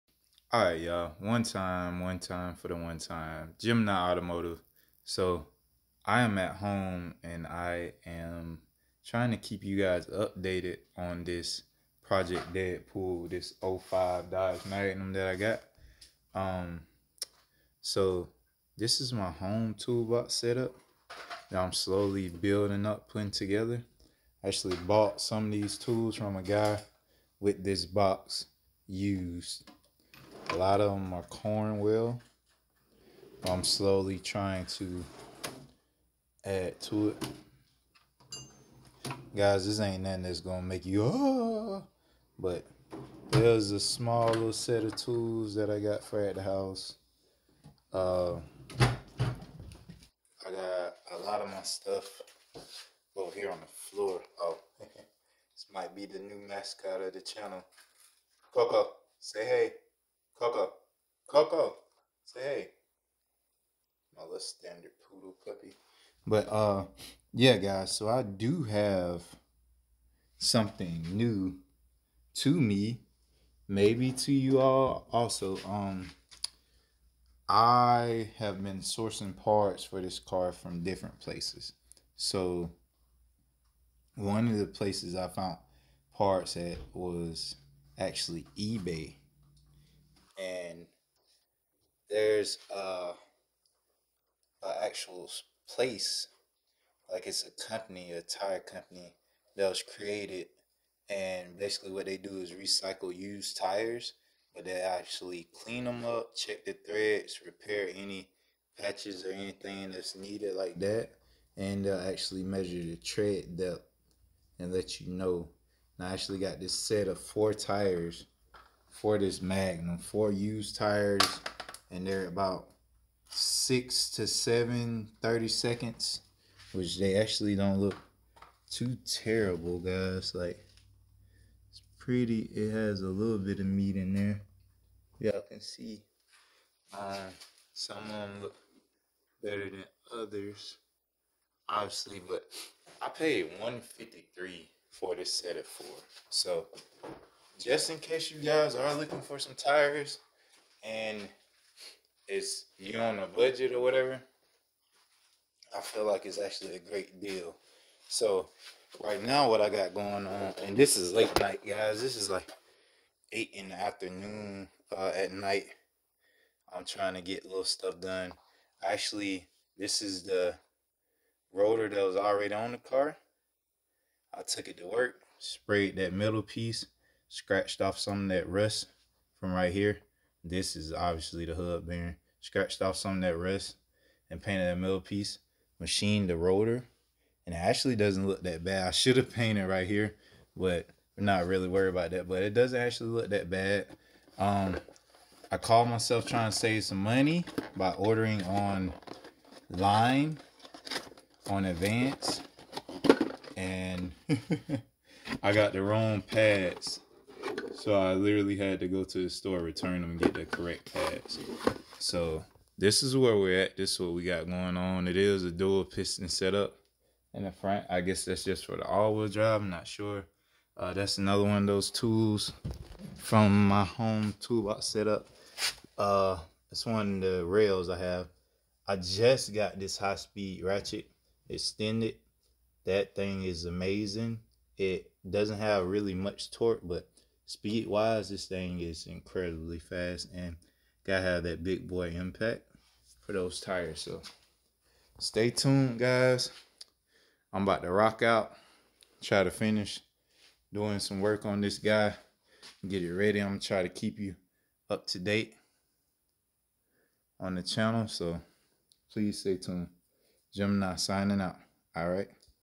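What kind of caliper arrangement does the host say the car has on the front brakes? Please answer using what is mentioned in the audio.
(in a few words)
Dual piston.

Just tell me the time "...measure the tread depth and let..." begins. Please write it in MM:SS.
01:52.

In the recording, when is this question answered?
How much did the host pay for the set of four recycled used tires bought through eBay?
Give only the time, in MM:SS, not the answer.
02:23.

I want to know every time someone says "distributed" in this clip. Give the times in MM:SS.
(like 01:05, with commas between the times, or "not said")
not said.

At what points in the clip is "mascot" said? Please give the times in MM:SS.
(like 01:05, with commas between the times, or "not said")
00:56.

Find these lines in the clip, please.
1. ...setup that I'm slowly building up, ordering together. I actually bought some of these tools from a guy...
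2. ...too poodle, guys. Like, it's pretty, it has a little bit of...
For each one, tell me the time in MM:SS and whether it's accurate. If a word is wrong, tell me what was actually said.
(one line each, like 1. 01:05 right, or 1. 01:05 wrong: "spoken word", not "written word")
1. 00:20 wrong: "putting", not "ordering"
2. 02:08 wrong: "terrible", not "poodle".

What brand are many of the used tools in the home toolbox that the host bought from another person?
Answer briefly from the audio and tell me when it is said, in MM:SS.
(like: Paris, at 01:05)
Cornwell, at 00:31.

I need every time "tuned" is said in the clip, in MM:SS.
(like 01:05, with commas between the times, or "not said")
04:05, 04:19.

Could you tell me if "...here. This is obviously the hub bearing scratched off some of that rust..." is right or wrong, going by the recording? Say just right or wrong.
right.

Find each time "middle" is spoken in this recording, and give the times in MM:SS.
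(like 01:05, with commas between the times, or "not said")
02:56, 03:04.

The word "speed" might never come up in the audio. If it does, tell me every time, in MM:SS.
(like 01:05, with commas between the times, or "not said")
03:49, 03:57.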